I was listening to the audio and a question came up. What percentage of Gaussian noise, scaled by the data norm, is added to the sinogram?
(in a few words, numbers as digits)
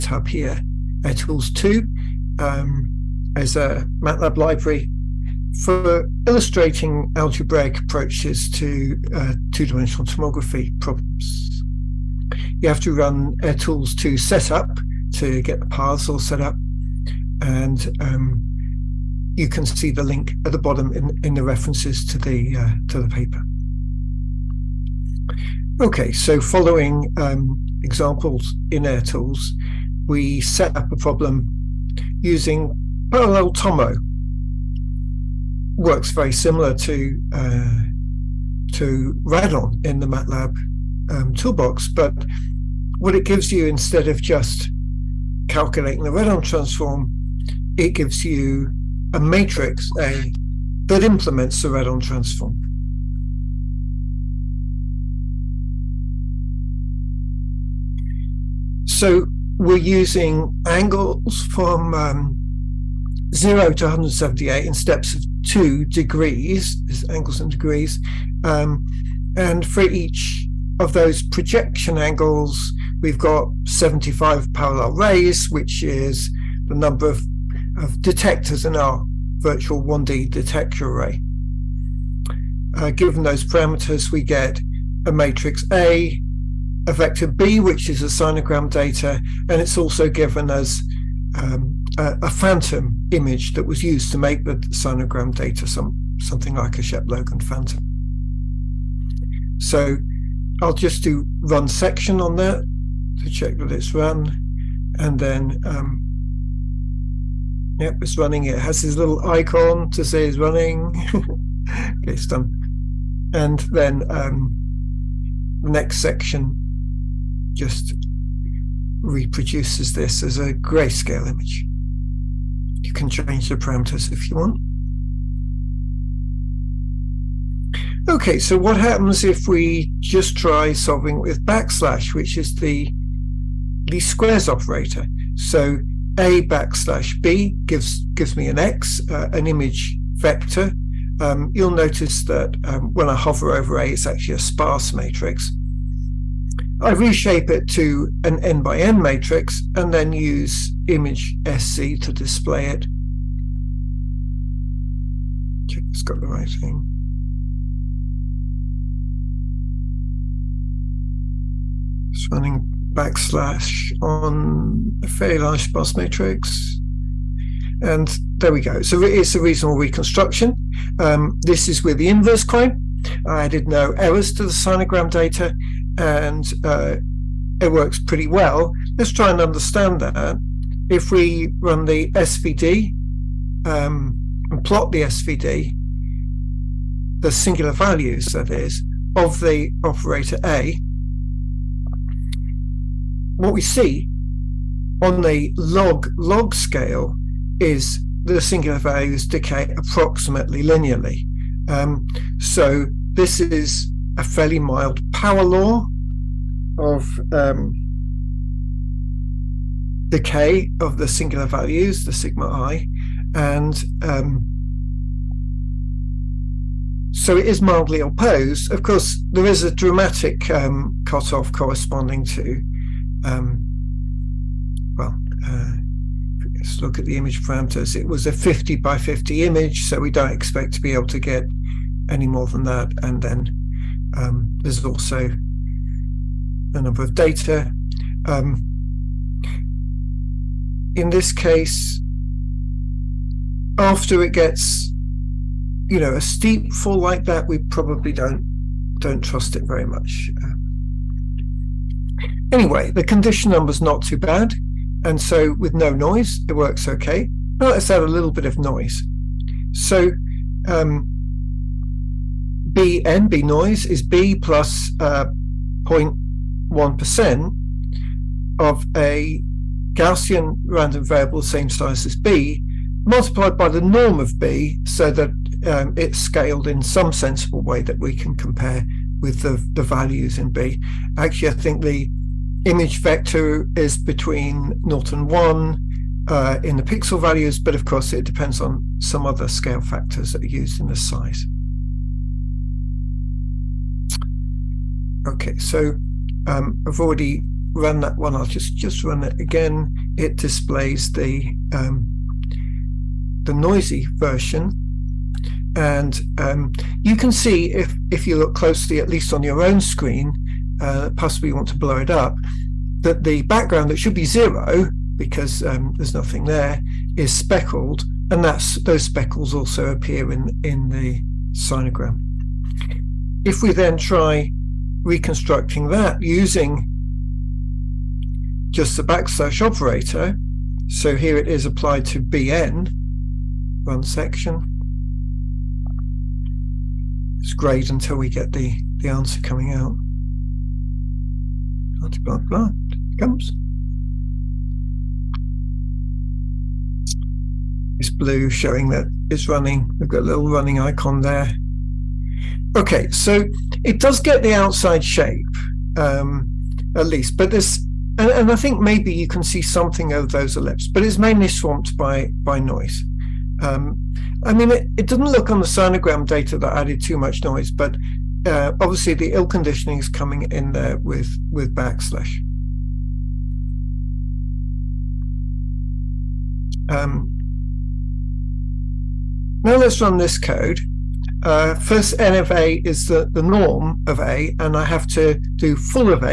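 0.1%.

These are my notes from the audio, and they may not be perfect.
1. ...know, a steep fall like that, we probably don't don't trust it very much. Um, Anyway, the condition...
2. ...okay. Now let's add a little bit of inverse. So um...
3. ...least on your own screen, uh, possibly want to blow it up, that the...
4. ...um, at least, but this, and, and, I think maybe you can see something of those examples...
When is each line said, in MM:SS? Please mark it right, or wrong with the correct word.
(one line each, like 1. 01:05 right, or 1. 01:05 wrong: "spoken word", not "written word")
1. 04:05 right
2. 04:16 wrong: "noise", not "inverse"
3. 05:09 right
4. 05:55 wrong: "ellipses", not "examples".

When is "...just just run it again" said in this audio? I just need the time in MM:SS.
04:58.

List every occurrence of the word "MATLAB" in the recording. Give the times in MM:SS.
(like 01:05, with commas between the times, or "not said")
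00:03, 00:40.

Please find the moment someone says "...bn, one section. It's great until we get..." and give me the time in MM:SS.
05:32.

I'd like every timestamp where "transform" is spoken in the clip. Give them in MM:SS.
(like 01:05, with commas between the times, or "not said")
00:46, 00:52.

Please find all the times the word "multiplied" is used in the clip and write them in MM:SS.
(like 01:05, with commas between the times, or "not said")
04:33.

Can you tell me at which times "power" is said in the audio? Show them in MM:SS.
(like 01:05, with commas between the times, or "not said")
03:25.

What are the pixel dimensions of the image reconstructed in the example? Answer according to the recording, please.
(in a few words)
50 by 50.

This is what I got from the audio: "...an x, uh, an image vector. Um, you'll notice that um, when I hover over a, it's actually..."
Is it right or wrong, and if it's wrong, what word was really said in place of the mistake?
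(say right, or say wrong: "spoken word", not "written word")
right.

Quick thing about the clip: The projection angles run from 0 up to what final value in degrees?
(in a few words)
178.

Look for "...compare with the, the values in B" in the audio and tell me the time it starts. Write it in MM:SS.
04:38.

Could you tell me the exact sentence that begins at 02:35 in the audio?
Check it's got the right thing.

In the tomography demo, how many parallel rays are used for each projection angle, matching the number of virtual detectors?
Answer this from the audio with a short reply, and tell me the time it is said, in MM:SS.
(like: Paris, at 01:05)
75, at 01:13.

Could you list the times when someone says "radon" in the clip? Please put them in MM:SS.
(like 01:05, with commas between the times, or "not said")
00:39, 00:46, 00:51.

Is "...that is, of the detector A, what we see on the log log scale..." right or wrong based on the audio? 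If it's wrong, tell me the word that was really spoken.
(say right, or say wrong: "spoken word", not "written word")
wrong: "operator", not "detector".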